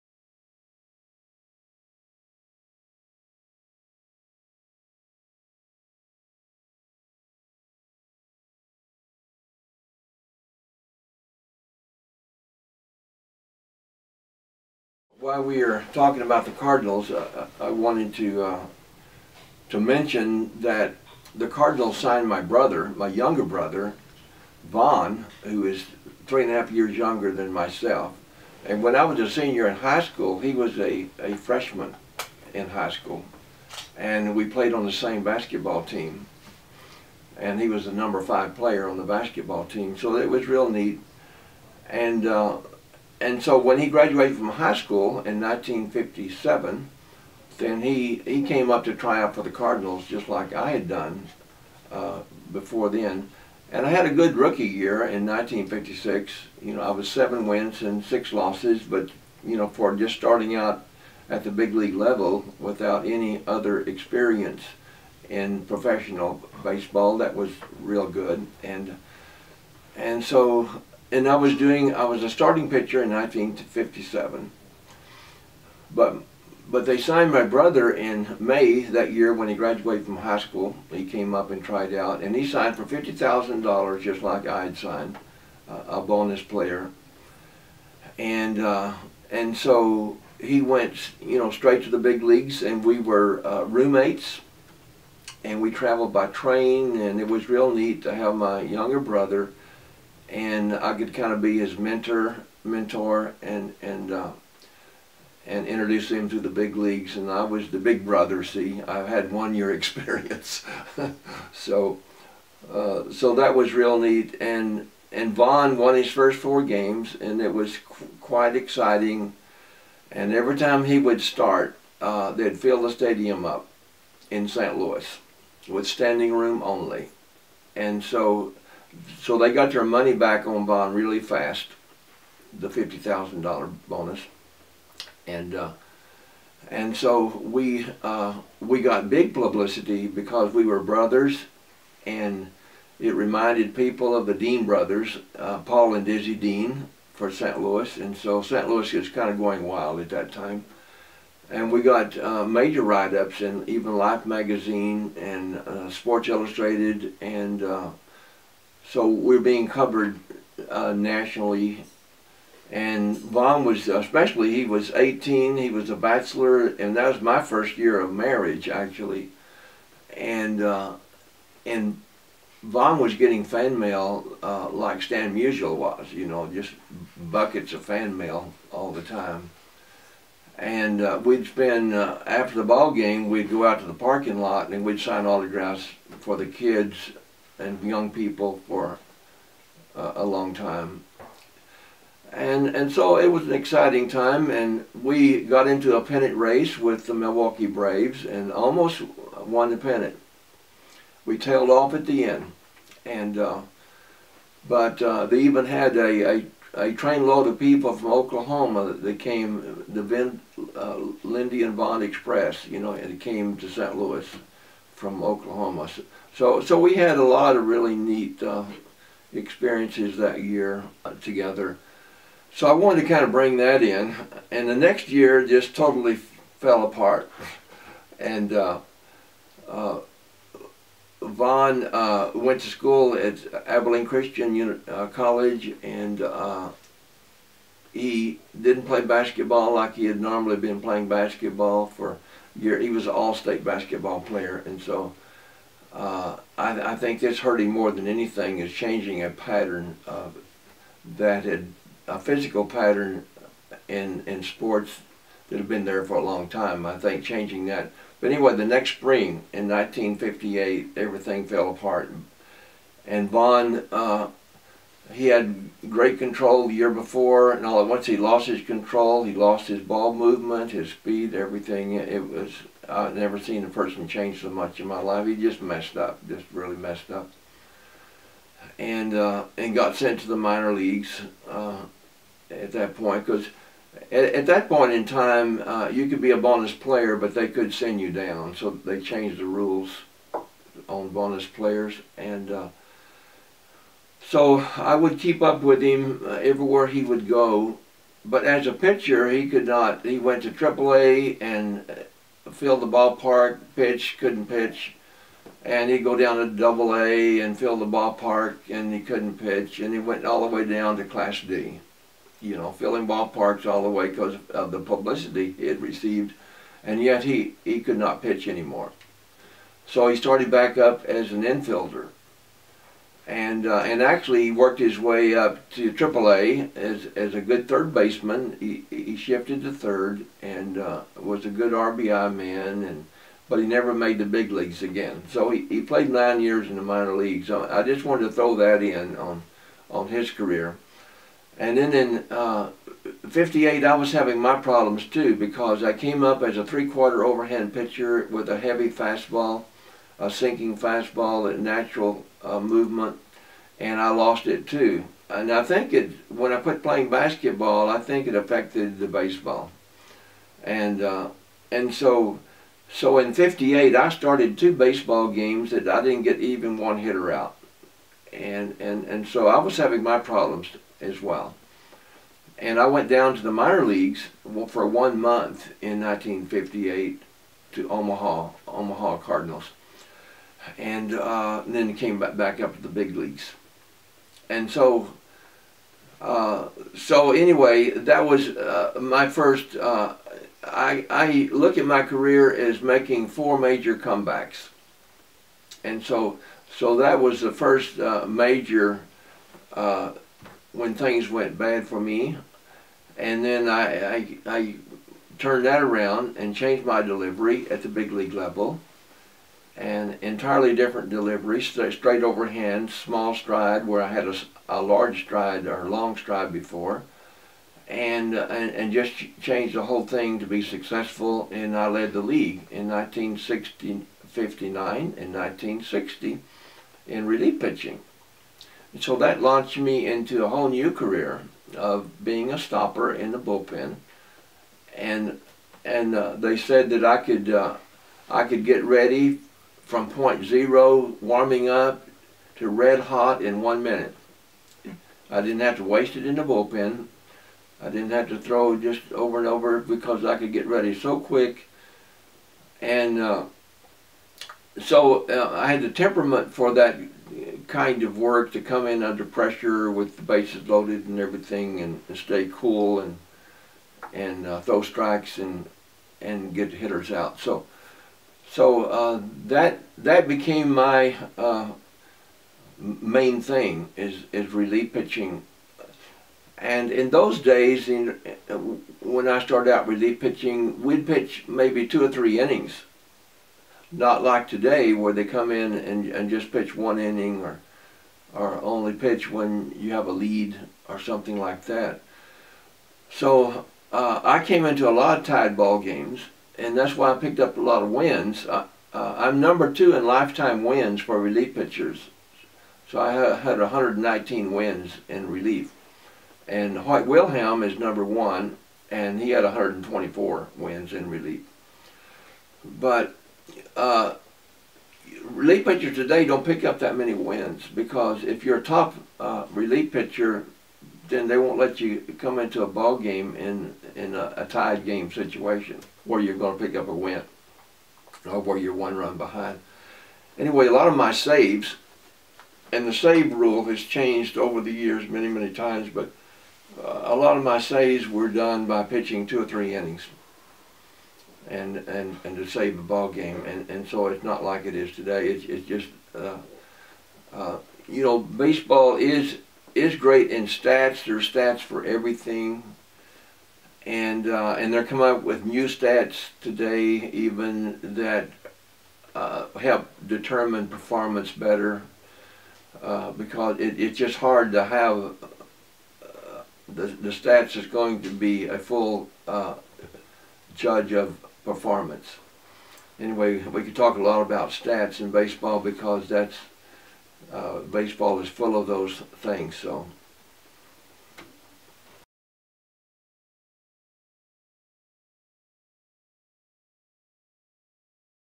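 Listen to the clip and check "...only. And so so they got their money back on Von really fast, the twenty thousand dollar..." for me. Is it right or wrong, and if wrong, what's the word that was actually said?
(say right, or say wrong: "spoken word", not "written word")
wrong: "fifty", not "twenty".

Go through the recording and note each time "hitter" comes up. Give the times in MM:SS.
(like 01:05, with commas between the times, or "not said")
06:06, 07:46.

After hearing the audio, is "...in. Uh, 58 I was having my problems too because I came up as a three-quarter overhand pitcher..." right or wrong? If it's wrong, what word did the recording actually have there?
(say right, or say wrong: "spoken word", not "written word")
right.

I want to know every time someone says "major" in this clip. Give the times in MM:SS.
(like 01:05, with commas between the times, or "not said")
02:32, 06:33, 06:38.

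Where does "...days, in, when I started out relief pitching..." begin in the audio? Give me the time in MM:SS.
07:57.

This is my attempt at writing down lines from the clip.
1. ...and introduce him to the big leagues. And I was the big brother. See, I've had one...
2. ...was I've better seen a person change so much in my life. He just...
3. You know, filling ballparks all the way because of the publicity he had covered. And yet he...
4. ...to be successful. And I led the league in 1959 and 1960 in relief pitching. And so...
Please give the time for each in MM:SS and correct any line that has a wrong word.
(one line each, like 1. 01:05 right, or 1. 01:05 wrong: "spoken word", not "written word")
1. 01:45 right
2. 04:32 wrong: "never", not "better"
3. 05:12 wrong: "received", not "covered"
4. 07:00 right.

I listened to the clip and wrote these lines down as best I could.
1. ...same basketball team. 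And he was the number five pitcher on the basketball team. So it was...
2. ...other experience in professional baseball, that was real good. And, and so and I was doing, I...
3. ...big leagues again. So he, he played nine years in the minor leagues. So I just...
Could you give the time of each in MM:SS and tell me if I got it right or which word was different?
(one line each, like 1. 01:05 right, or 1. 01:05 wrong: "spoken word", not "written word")
1. 00:34 wrong: "player", not "pitcher"
2. 01:03 right
3. 05:34 right.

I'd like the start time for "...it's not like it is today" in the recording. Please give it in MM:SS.
09:04.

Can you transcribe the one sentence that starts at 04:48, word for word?
So they changed the rules on bonus players and.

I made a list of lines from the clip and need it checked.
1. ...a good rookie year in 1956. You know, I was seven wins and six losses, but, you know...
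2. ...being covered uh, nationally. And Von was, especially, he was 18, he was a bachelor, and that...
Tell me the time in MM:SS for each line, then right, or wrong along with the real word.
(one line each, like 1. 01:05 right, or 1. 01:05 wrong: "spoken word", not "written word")
1. 00:54 right
2. 02:39 right.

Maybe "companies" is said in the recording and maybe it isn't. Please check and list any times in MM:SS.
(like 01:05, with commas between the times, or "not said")
not said.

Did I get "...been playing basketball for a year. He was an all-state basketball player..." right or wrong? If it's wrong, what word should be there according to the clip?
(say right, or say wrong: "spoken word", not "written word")
right.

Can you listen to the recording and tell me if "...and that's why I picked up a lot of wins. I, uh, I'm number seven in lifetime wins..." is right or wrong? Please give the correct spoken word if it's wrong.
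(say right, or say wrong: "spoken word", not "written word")
wrong: "two", not "seven".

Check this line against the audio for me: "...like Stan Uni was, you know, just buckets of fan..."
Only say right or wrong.
wrong.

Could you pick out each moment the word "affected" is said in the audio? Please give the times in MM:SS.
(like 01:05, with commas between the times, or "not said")
05:58.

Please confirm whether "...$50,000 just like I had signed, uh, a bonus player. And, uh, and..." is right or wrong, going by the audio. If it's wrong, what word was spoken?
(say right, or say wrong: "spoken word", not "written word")
right.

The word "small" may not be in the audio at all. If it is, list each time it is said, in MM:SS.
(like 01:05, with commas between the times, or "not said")
06:52.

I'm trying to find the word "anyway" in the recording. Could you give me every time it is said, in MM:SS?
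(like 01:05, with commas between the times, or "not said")
04:18, 06:27, 08:50, 09:32.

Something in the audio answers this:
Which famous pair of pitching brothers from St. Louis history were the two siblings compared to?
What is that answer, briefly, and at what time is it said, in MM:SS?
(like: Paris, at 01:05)
Dean brothers, at 02:24.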